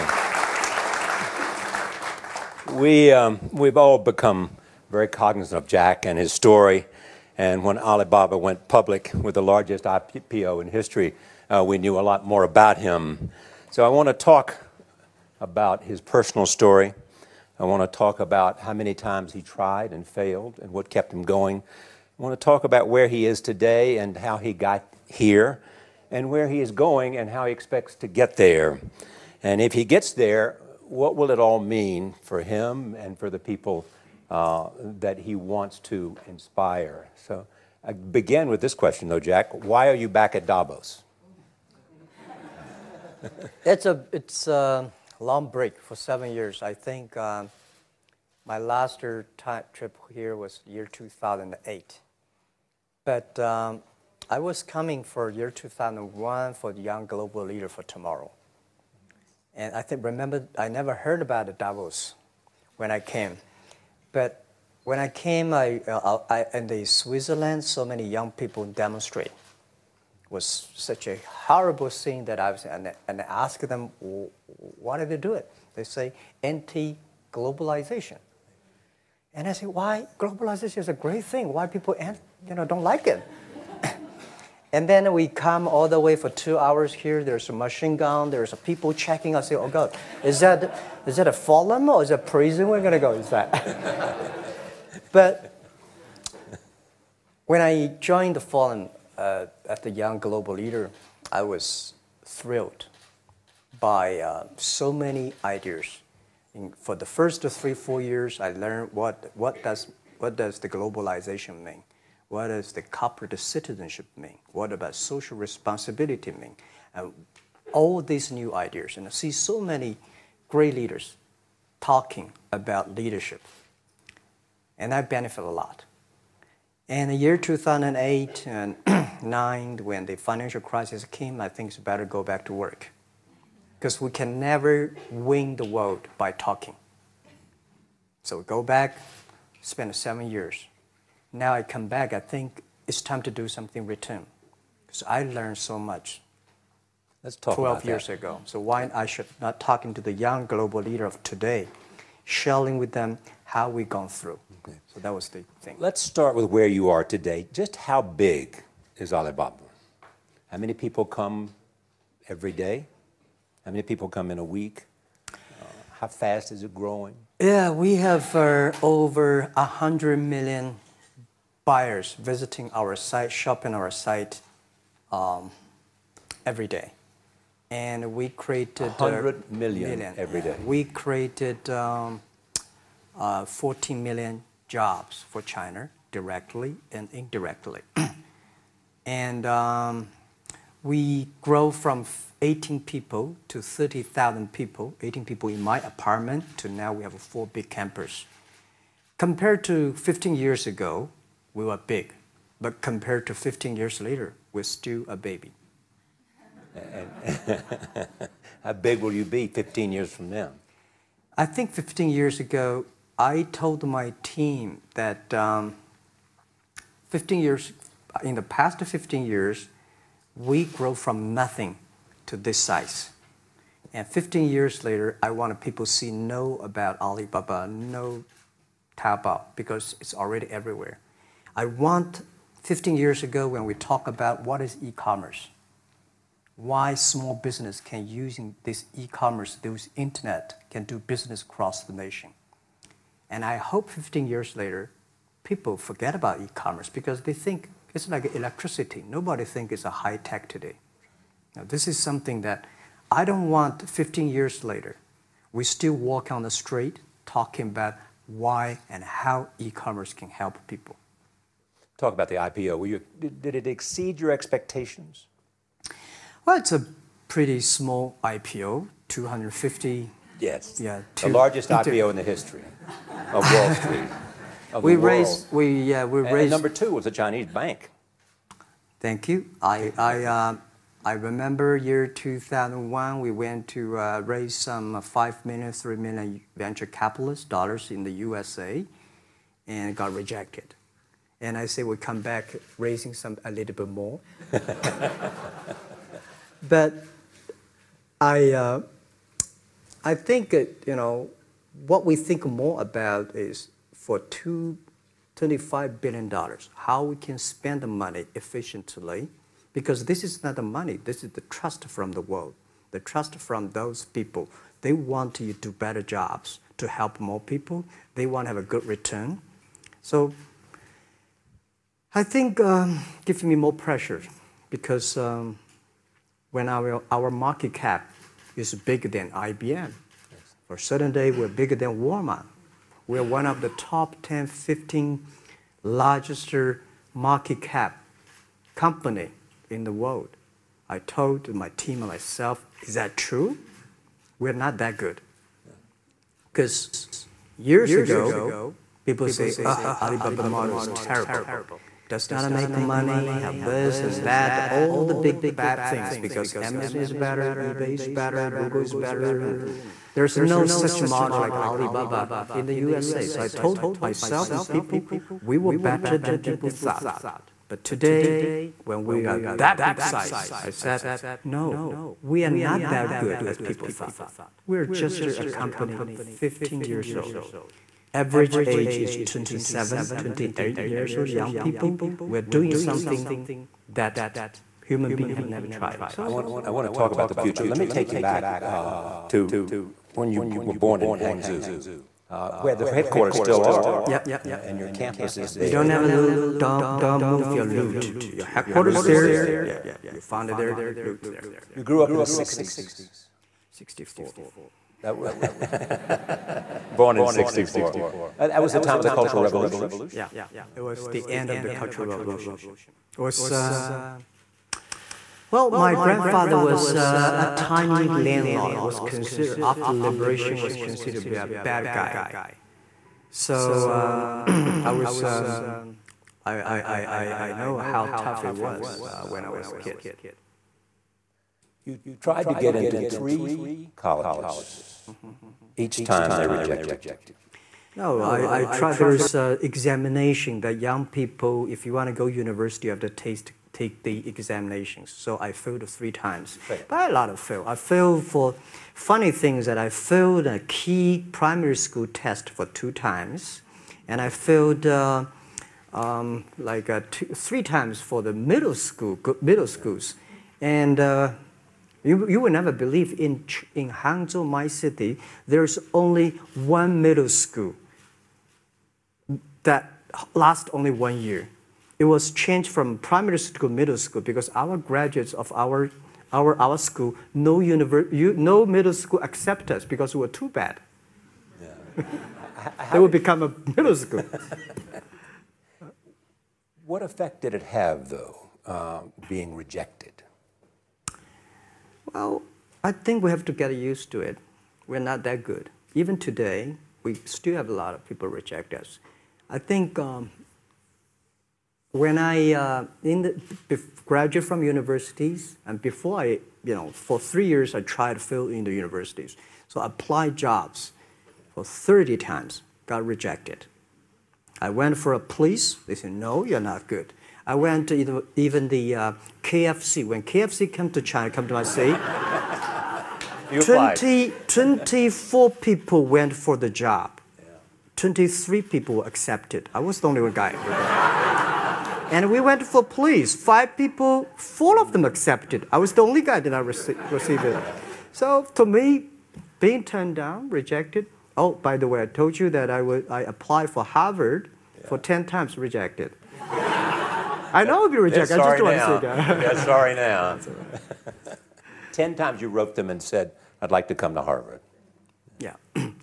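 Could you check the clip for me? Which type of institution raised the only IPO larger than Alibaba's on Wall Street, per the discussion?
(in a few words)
A Chinese bank.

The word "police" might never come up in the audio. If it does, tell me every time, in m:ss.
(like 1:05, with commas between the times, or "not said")
8:35, 8:52.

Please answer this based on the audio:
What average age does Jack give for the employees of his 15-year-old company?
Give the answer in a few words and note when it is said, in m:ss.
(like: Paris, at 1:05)
27, 28, at 6:19.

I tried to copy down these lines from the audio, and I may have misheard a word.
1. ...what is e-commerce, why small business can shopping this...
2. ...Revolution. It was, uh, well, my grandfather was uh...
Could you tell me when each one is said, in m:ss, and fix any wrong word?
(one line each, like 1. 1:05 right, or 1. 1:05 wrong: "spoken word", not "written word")
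1. 3:54 wrong: "using", not "shopping"
2. 6:52 right.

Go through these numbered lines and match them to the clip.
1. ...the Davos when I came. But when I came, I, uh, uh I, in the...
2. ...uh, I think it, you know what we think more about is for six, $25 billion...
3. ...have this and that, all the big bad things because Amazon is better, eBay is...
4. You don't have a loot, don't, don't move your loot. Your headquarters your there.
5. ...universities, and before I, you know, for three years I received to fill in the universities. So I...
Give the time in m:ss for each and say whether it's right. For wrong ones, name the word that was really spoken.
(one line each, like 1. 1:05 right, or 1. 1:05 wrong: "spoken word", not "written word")
1. 1:01 right
2. 4:58 wrong: "two", not "six"
3. 5:53 right
4. 6:35 right
5. 8:24 wrong: "tried", not "received".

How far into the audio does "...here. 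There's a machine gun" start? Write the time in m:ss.
1:26.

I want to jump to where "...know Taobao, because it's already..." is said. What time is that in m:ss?
3:47.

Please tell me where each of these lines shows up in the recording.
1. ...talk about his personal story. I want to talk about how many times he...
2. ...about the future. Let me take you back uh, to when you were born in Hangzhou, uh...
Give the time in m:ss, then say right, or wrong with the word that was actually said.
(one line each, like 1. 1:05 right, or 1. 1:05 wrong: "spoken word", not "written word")
1. 0:14 right
2. 6:27 right.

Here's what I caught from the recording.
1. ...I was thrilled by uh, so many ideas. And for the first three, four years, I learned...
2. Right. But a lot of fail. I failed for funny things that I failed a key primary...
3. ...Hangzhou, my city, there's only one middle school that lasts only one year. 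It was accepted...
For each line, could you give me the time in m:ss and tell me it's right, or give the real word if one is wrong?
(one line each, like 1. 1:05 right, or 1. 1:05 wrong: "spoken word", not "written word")
1. 1:41 right
2. 7:26 right
3. 7:43 wrong: "changed", not "accepted".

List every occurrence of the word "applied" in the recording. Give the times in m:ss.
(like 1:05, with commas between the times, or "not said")
8:29, 9:03.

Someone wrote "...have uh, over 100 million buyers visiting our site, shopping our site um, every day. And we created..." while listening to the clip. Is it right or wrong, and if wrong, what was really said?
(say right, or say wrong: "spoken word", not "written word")
right.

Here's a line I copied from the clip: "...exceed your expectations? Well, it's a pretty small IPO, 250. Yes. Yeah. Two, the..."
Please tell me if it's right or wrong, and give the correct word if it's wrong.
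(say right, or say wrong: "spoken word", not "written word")
right.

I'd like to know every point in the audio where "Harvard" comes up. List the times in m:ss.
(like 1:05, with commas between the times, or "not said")
9:03, 9:14.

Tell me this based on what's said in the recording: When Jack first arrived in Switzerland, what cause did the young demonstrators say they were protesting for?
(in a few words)
Anti-globalization.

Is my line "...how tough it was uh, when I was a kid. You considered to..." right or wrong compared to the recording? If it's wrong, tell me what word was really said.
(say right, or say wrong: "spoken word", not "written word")
wrong: "tried", not "considered".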